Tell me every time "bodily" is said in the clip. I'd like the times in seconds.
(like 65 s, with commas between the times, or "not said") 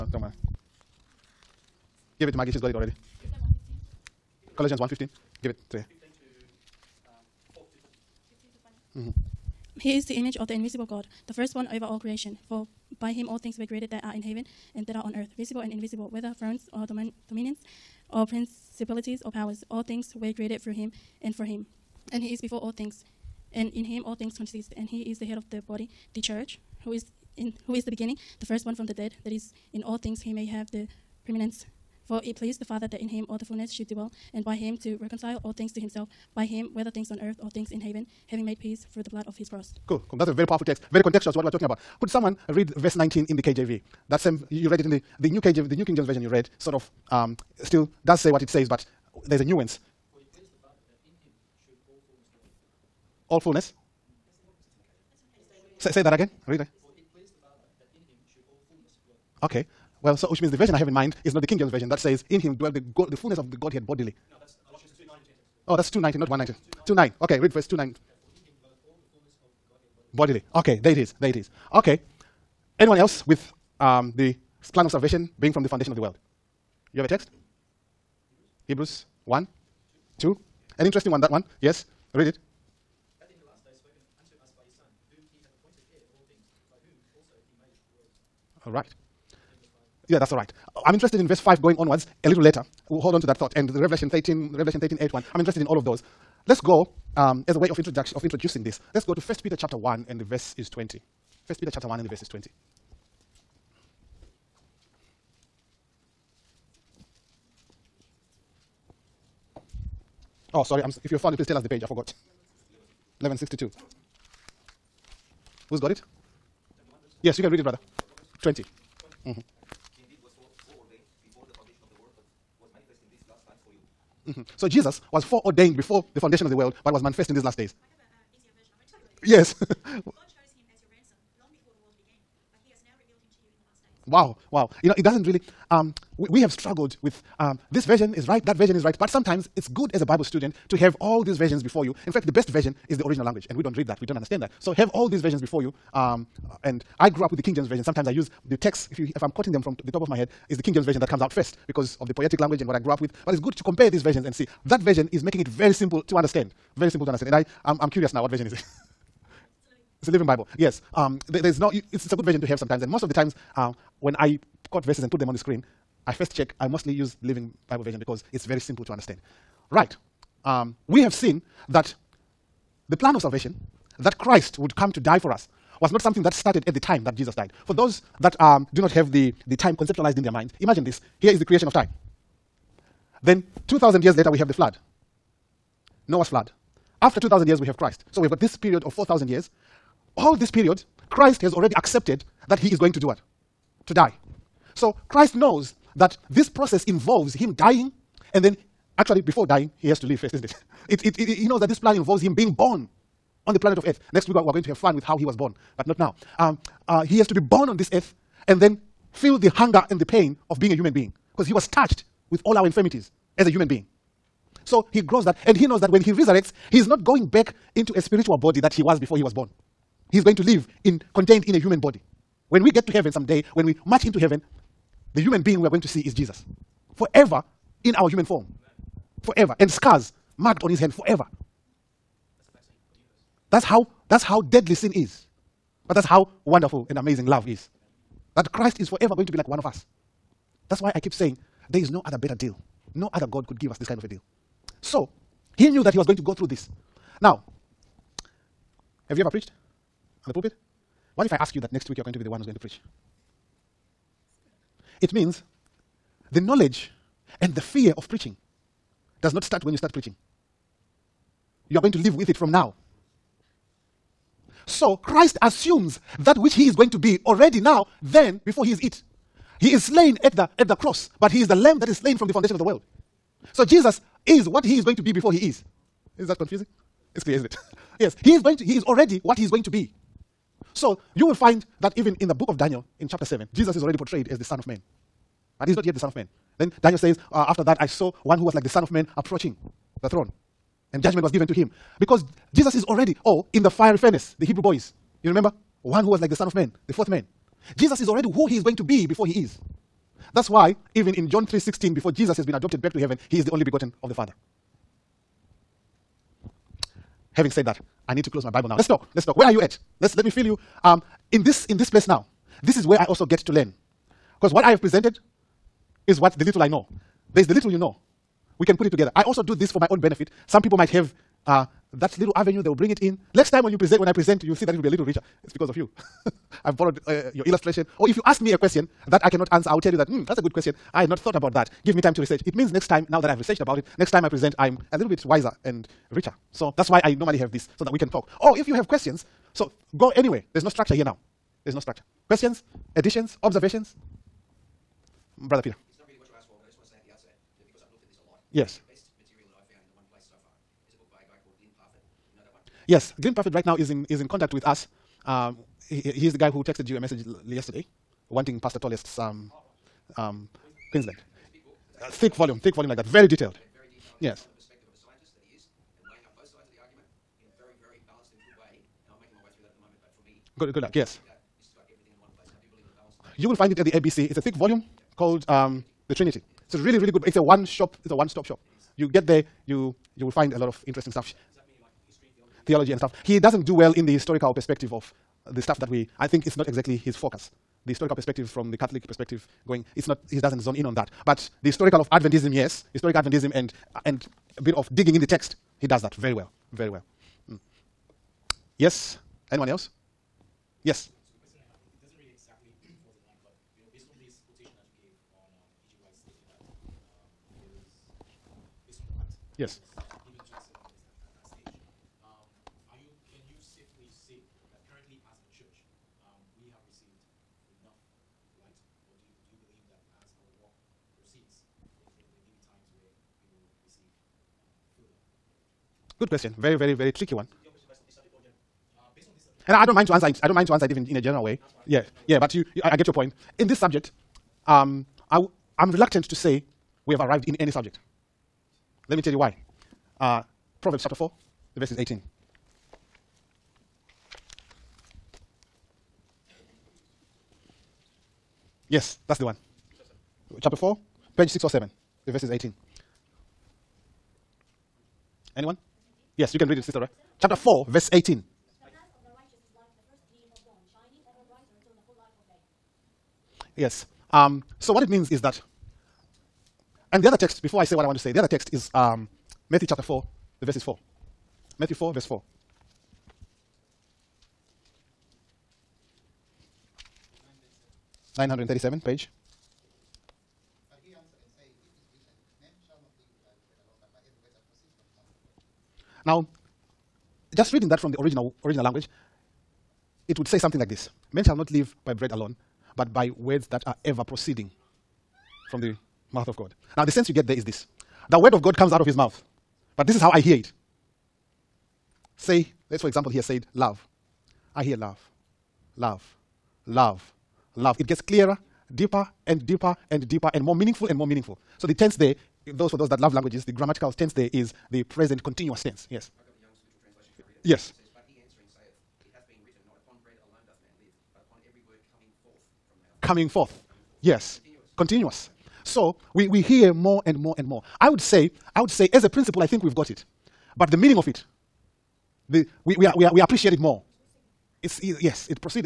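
63 s, 70 s.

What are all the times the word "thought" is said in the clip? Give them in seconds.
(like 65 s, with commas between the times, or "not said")
93 s, 331 s.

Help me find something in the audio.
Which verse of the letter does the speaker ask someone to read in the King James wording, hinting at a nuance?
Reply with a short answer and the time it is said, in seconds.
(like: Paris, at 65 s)
Verse 19, at 42 s.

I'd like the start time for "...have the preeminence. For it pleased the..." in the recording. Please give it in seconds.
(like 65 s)
30 s.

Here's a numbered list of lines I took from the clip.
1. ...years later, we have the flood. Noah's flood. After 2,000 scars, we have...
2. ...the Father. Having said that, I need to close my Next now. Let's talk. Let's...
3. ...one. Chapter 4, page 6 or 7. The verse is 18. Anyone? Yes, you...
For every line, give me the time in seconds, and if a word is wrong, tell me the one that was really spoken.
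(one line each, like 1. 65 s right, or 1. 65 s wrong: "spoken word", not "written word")
1. 184 s wrong: "years", not "scars"
2. 304 s wrong: "Bible", not "Next"
3. 449 s right.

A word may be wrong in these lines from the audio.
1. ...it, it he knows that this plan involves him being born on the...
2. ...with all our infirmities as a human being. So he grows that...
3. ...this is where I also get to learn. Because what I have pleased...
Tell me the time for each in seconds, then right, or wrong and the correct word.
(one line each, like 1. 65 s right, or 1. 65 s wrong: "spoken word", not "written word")
1. 201 s right
2. 212 s right
3. 312 s wrong: "presented", not "pleased".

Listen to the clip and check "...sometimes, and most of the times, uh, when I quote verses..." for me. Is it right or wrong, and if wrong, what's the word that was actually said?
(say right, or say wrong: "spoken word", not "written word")
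right.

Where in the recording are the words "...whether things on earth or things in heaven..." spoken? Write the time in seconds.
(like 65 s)
36 s.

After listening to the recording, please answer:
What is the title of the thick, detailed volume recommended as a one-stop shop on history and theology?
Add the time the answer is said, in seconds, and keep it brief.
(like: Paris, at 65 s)
The Trinity, at 376 s.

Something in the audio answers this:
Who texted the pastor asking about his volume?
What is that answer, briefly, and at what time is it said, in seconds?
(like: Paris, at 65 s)
Glenn Perford, at 353 s.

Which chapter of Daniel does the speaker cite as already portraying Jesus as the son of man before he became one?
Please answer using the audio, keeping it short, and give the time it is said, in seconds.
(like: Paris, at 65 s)
Chapter 7, at 283 s.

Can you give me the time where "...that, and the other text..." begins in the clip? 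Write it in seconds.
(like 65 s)
465 s.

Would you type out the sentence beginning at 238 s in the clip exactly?
That Christ is forever going to be like one of us.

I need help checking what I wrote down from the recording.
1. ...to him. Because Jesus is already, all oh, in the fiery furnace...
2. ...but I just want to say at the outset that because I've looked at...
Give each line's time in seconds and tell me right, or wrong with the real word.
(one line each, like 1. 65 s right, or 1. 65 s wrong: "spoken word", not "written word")
1. 291 s right
2. 346 s right.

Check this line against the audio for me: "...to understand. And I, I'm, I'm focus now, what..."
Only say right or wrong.
wrong.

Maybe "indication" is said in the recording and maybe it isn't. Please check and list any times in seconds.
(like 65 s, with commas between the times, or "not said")
not said.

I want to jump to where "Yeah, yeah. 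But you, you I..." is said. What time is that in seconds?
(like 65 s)
431 s.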